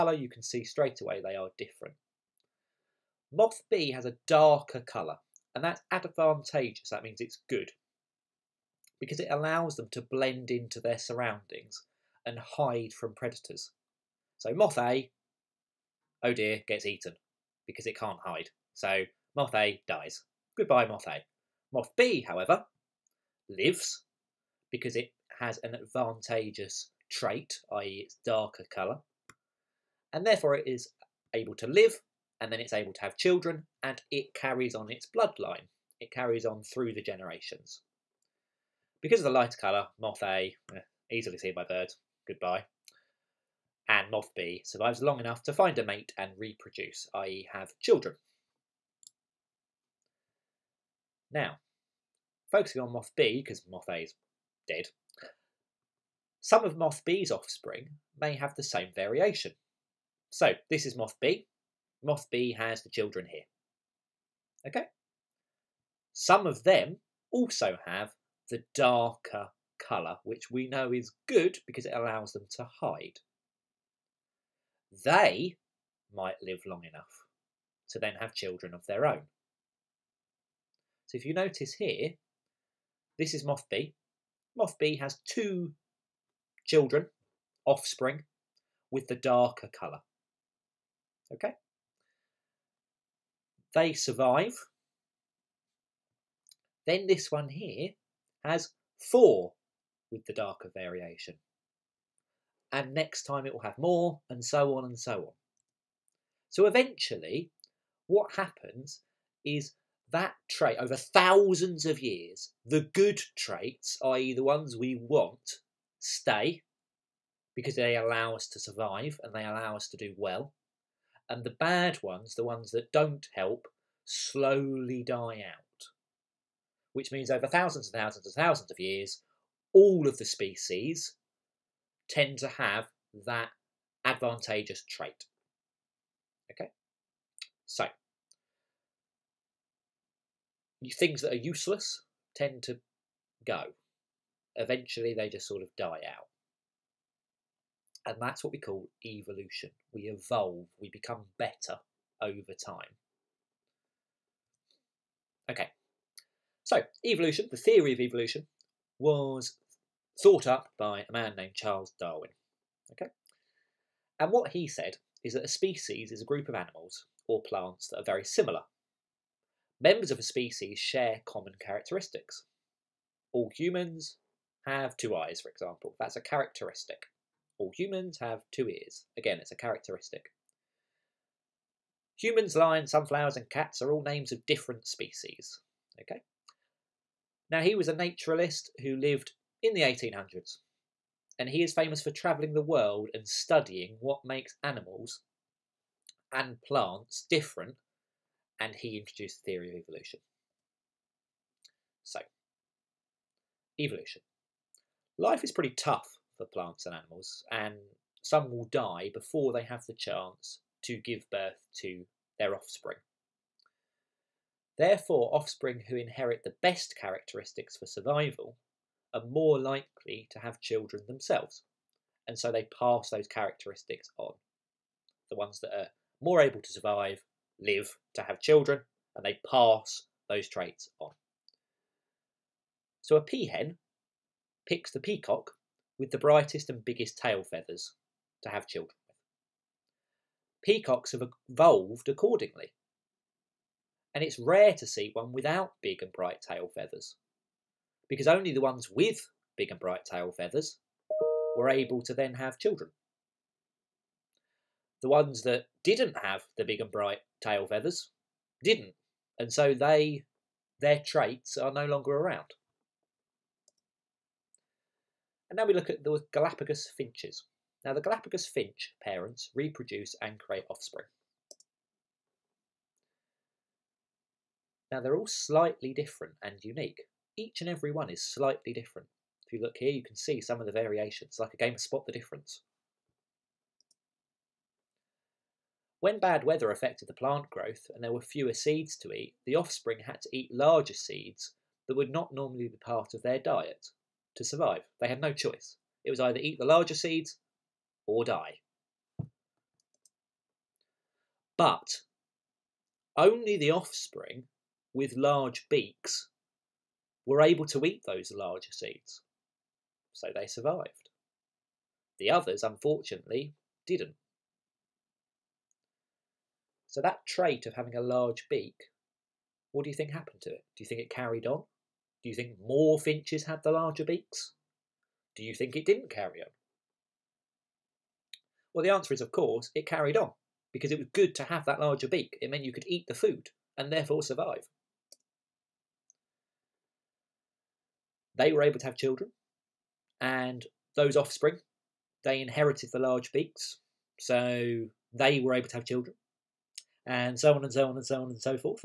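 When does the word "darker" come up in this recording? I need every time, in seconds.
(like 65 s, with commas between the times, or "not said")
4 s, 28 s, 68 s, 89 s, 100 s.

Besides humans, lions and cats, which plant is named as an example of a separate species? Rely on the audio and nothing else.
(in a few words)
Sunflowers.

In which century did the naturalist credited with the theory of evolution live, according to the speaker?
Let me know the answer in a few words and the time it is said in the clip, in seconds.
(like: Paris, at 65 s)
1800s, at 189 s.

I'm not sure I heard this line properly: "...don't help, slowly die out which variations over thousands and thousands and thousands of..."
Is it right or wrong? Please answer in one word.
wrong.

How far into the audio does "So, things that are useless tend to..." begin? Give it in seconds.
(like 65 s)
137 s.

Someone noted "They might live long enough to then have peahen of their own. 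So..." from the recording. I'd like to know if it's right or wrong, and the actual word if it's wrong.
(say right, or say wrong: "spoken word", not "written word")
wrong: "children", not "peahen".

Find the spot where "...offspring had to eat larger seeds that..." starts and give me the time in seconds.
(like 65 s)
289 s.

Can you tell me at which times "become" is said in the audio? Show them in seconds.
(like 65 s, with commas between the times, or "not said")
150 s.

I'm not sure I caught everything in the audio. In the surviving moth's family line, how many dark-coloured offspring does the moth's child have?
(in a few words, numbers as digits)
4.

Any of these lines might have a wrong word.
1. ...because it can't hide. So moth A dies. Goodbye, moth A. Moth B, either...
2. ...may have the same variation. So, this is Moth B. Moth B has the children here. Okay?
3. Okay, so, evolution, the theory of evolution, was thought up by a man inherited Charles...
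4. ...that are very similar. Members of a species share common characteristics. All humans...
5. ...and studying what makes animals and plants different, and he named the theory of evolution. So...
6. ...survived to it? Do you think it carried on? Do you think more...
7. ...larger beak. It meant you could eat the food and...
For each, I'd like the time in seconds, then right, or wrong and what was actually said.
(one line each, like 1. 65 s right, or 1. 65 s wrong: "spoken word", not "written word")
1. 17 s wrong: "however", not "either"
2. 58 s right
3. 155 s wrong: "named", not "inherited"
4. 167 s right
5. 193 s wrong: "introduced", not "named"
6. 320 s wrong: "happened", not "survived"
7. 331 s right.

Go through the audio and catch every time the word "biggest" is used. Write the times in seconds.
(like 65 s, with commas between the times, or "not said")
236 s.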